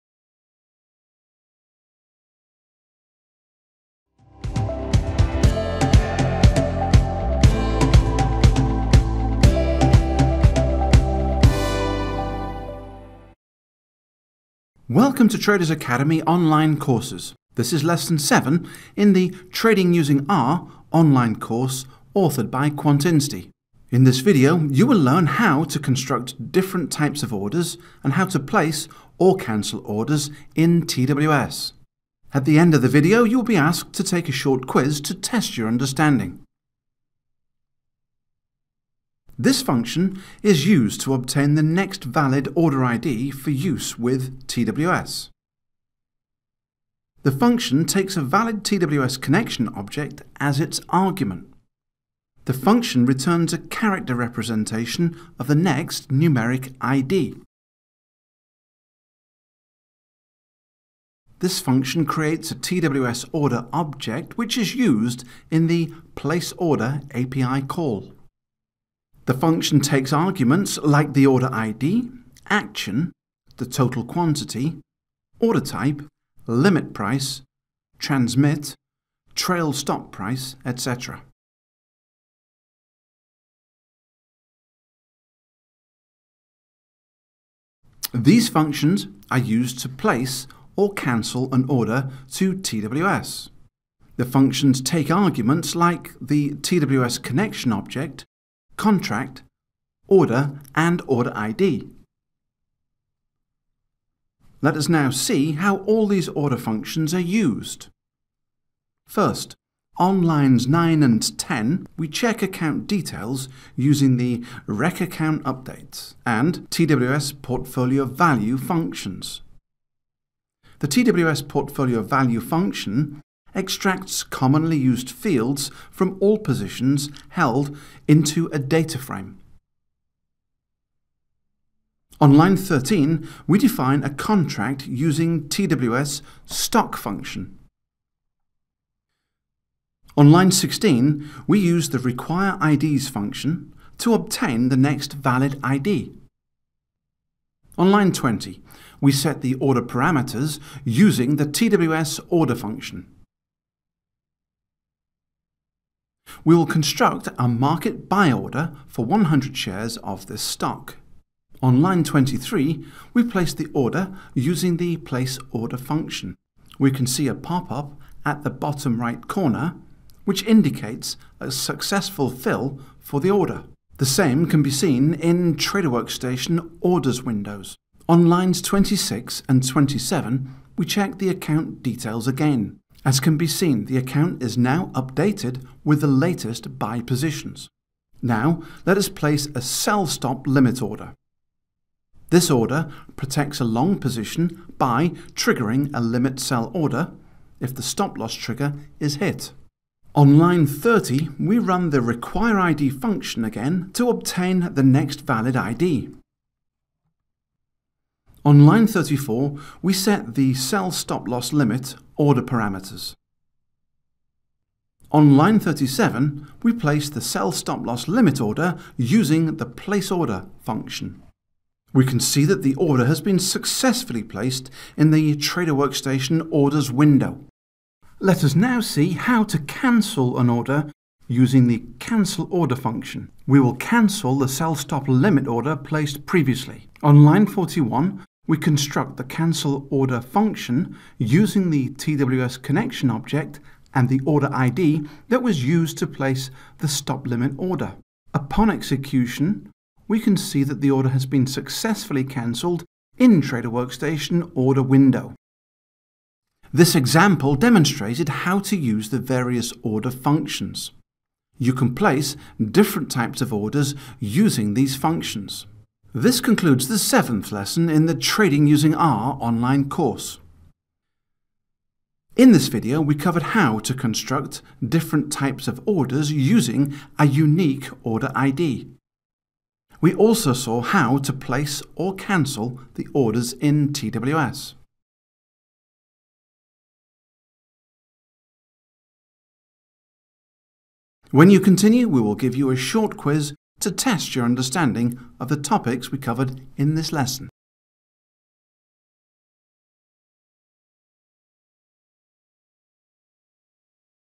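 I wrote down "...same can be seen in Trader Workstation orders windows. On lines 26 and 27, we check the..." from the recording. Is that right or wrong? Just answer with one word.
right.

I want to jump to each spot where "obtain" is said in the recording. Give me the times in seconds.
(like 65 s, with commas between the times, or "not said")
41 s, 144 s, 204 s.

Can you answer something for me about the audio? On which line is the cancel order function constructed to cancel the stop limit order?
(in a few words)
41.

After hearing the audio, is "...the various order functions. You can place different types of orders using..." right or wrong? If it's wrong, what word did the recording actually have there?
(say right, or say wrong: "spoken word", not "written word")
right.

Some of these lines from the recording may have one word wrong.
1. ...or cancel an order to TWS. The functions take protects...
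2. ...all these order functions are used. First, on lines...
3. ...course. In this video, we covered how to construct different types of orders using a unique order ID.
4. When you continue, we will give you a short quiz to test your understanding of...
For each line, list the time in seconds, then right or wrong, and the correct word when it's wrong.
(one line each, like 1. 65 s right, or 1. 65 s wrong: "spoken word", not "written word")
1. 90 s wrong: "arguments", not "protects"
2. 105 s right
3. 269 s right
4. 291 s right.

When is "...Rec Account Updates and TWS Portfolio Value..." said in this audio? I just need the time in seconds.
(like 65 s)
114 s.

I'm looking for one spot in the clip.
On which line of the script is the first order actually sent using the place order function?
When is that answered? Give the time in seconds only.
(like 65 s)
161 s.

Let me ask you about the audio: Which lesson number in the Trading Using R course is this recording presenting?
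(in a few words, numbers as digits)
7.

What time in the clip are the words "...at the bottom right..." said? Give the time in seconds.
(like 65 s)
168 s.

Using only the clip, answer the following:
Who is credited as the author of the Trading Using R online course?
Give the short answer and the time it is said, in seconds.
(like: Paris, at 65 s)
Quantinsti, at 22 s.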